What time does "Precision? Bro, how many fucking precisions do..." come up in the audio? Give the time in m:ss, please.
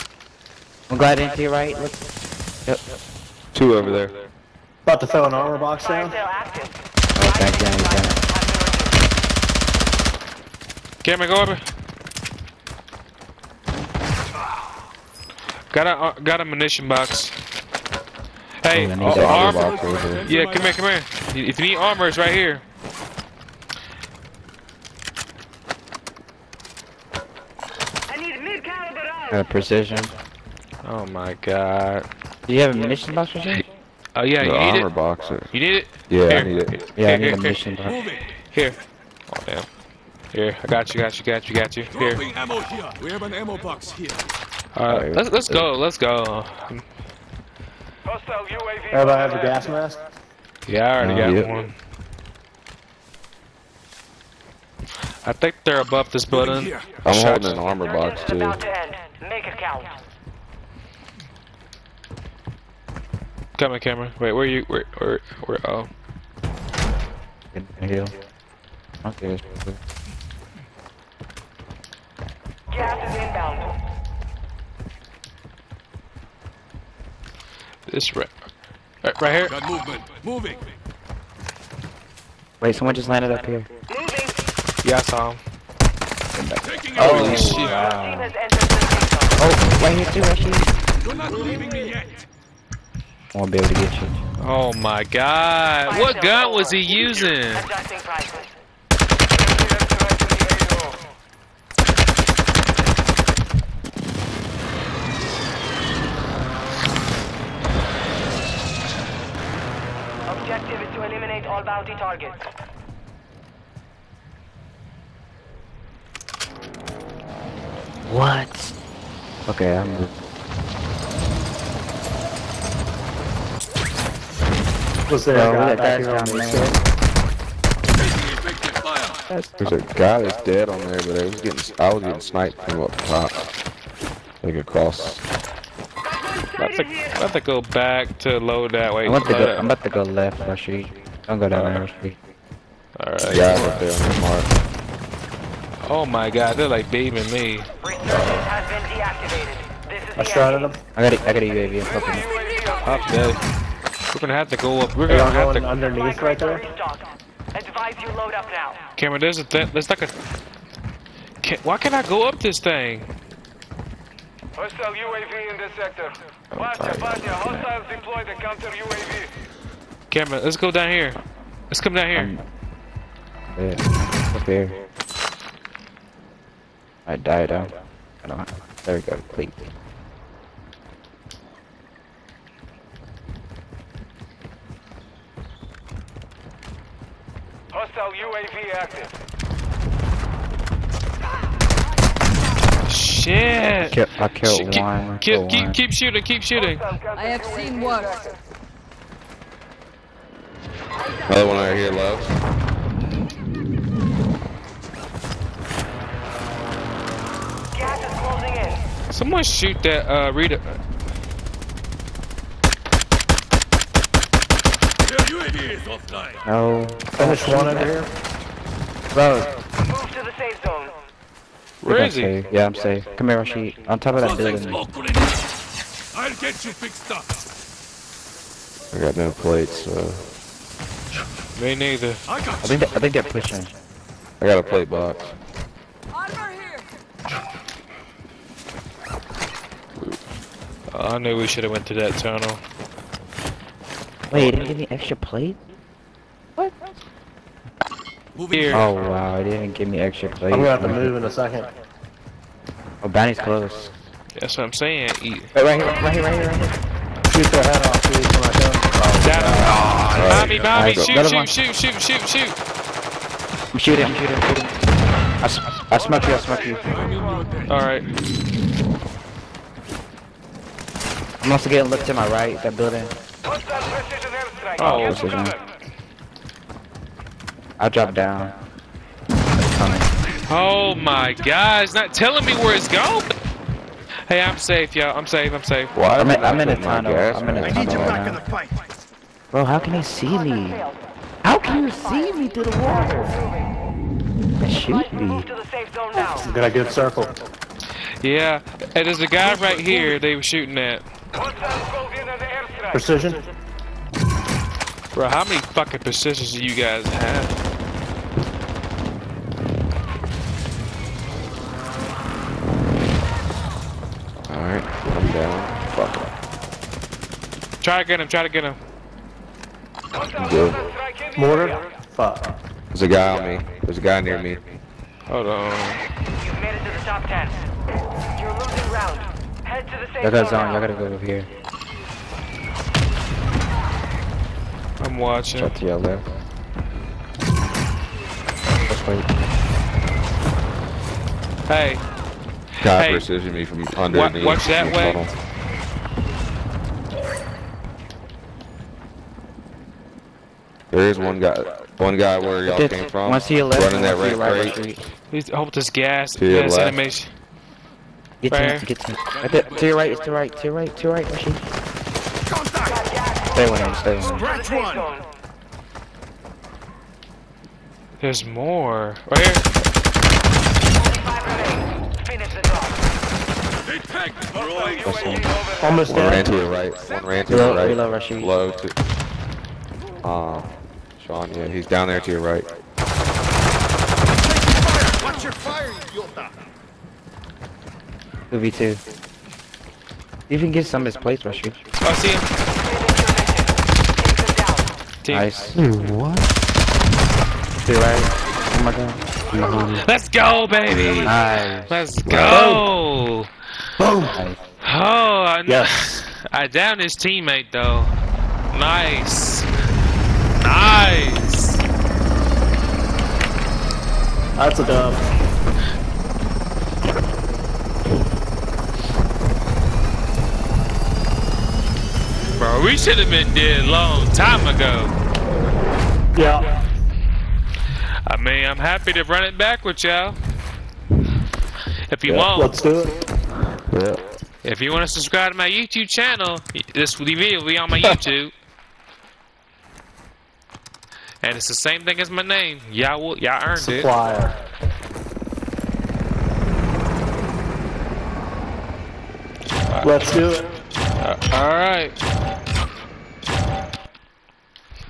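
5:02.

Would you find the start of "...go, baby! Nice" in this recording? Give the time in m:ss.
6:40.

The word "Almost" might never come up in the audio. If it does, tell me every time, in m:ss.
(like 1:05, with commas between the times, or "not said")
6:15.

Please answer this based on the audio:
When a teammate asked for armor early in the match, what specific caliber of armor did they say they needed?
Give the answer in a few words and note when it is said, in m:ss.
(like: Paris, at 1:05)
Mid-caliber armor, at 0:28.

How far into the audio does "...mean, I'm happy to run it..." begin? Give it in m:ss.
7:08.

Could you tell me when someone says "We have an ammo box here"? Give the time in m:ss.
0:43.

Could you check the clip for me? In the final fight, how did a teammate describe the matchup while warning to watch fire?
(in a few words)
2v2.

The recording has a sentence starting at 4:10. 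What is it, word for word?
I'm gonna have to move in a second.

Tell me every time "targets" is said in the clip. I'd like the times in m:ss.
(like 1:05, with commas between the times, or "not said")
1:51.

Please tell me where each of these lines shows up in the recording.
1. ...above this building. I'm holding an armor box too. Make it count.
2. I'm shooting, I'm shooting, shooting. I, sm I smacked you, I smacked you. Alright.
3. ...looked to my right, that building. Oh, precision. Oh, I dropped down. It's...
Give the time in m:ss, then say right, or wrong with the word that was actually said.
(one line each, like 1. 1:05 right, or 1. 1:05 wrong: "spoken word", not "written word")
1. 0:55 right
2. 4:23 right
3. 4:31 right.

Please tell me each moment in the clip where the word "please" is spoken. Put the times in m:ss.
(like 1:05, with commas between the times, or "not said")
2:59, 4:18.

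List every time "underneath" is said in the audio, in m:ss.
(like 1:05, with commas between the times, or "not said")
2:35, 5:43.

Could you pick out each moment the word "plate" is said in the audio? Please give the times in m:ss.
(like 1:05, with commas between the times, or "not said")
3:49, 3:54, 4:05, 4:10, 6:31.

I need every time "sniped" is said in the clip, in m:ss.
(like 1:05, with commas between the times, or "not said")
2:12.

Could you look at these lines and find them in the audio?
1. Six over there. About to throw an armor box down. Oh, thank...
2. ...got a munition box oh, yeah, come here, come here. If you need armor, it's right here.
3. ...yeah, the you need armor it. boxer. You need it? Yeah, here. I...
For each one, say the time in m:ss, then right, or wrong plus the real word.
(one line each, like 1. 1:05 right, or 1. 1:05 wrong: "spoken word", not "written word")
1. 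0:03 wrong: "Two", not "Six"
2. 0:16 right
3. 0:34 right.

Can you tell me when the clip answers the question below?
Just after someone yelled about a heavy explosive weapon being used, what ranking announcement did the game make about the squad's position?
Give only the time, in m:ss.
5:27.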